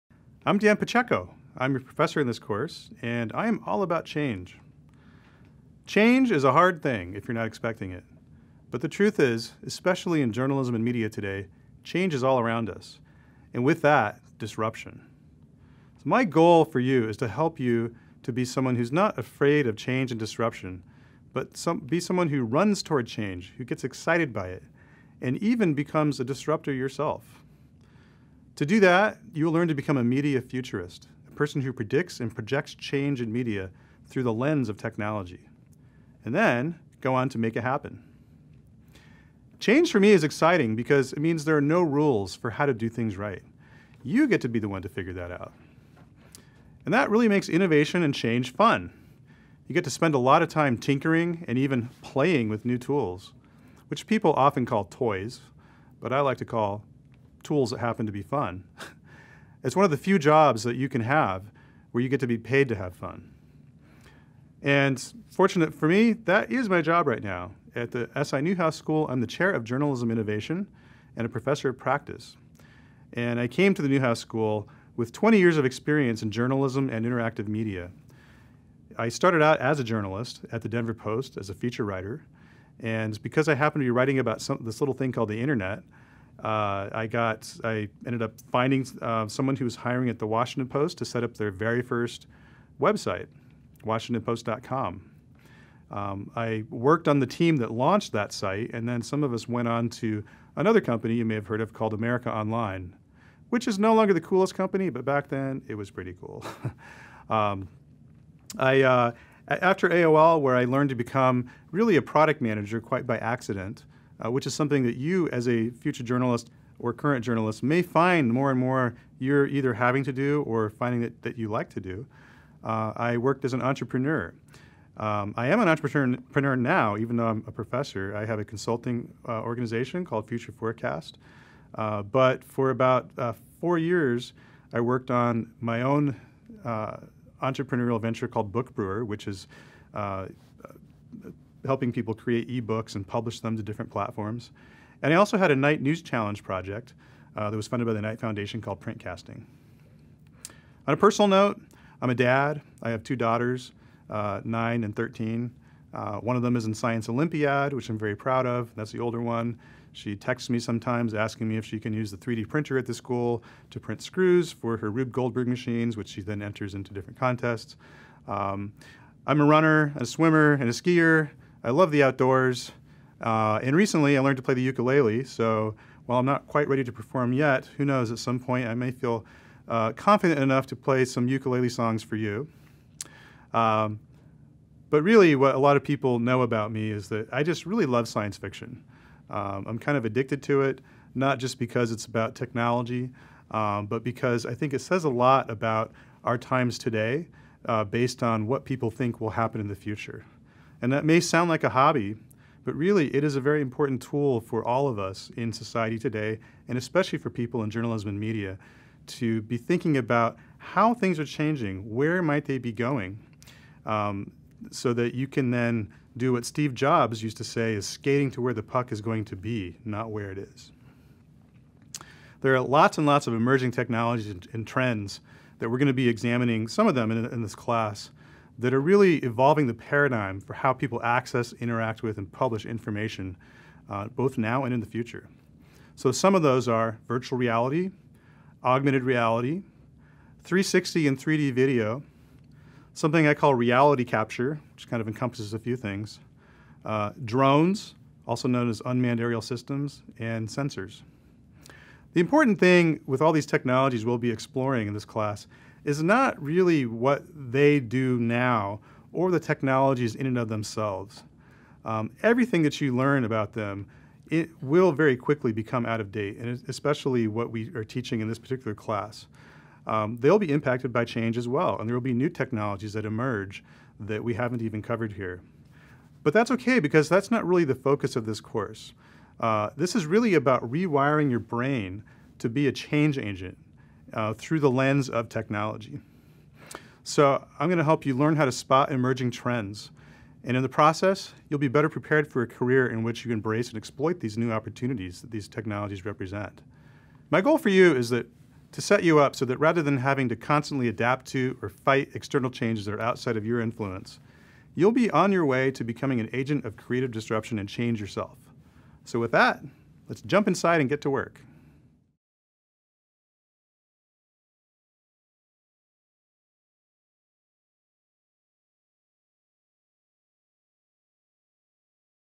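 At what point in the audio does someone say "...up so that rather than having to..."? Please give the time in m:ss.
4:59.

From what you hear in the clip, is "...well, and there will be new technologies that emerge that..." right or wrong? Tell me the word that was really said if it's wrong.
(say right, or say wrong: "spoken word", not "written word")
right.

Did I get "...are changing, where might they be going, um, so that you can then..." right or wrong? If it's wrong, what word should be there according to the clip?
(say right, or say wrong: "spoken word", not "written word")
right.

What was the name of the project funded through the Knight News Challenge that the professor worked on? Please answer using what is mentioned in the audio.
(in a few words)
Printcasting.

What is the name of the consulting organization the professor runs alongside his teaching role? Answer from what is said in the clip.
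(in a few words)
Future Forecast.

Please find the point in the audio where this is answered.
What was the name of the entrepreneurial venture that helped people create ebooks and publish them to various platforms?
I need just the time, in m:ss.
2:18.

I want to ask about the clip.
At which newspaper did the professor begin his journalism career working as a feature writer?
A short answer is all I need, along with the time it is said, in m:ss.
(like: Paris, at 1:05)
Denver Post, at 1:20.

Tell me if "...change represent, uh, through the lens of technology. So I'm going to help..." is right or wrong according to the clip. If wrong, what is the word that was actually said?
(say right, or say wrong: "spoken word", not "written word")
wrong: "agent", not "represent".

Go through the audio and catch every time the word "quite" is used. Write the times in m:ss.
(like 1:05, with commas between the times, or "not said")
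1:52, 2:56.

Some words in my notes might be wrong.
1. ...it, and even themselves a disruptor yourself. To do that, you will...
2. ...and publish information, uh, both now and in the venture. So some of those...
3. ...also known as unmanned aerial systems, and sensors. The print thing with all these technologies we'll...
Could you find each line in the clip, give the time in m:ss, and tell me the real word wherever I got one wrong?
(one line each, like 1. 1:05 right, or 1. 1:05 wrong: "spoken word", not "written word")
1. 0:24 wrong: "becomes", not "themselves"
2. 3:52 wrong: "future", not "venture"
3. 4:08 wrong: "important", not "print".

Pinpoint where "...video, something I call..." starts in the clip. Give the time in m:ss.
4:01.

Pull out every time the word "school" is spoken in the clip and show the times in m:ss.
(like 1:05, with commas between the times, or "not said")
1:08, 1:14, 2:42.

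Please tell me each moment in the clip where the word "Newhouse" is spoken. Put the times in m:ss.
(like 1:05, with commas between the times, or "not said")
1:08, 1:13.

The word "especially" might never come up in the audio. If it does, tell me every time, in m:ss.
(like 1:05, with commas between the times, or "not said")
0:09, 3:26, 4:26.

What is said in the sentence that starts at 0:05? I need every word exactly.
Change is a hard thing if you're not expecting it.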